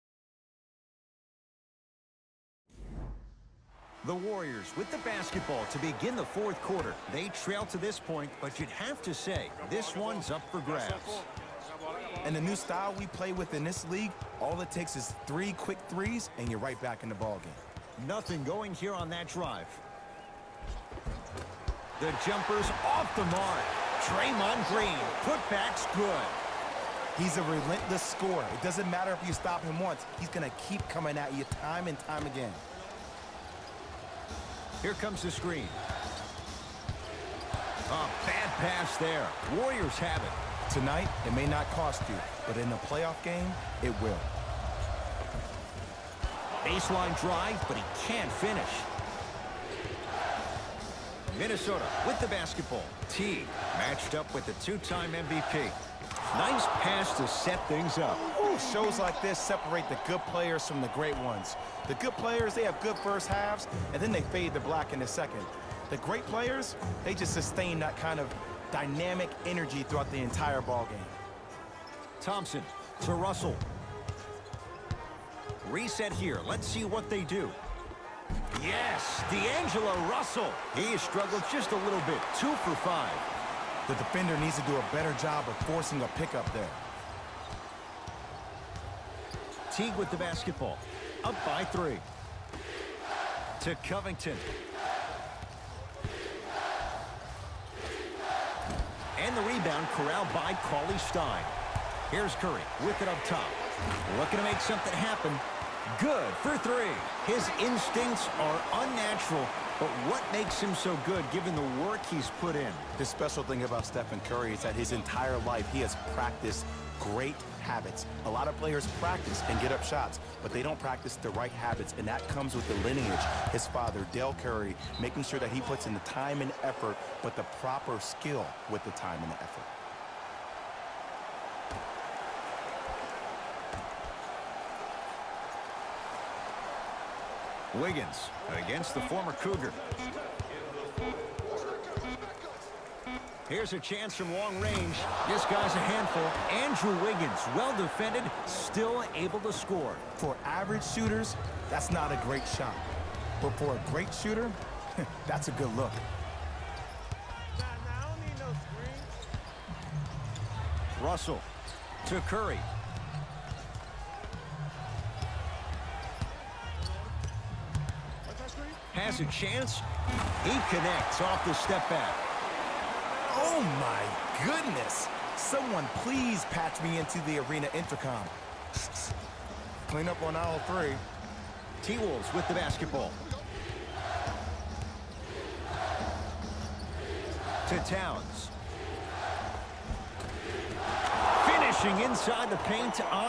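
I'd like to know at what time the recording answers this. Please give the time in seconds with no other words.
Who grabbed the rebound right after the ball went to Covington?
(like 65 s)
100 s.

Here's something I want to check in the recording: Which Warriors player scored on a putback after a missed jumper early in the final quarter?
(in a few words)
Draymond Green.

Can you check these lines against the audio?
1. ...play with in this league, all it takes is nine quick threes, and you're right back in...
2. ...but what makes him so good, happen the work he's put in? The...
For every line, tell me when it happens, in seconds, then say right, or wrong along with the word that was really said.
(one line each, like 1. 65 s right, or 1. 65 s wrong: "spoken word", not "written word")
1. 13 s wrong: "three", not "nine"
2. 109 s wrong: "given", not "happen".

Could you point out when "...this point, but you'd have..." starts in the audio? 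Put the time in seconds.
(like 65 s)
7 s.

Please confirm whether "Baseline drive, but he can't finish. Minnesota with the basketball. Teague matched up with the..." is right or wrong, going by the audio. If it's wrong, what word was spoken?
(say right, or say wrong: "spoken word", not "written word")
right.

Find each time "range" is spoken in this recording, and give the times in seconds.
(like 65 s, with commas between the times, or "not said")
144 s.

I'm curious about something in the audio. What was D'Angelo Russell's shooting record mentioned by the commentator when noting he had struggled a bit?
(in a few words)
2 for 5.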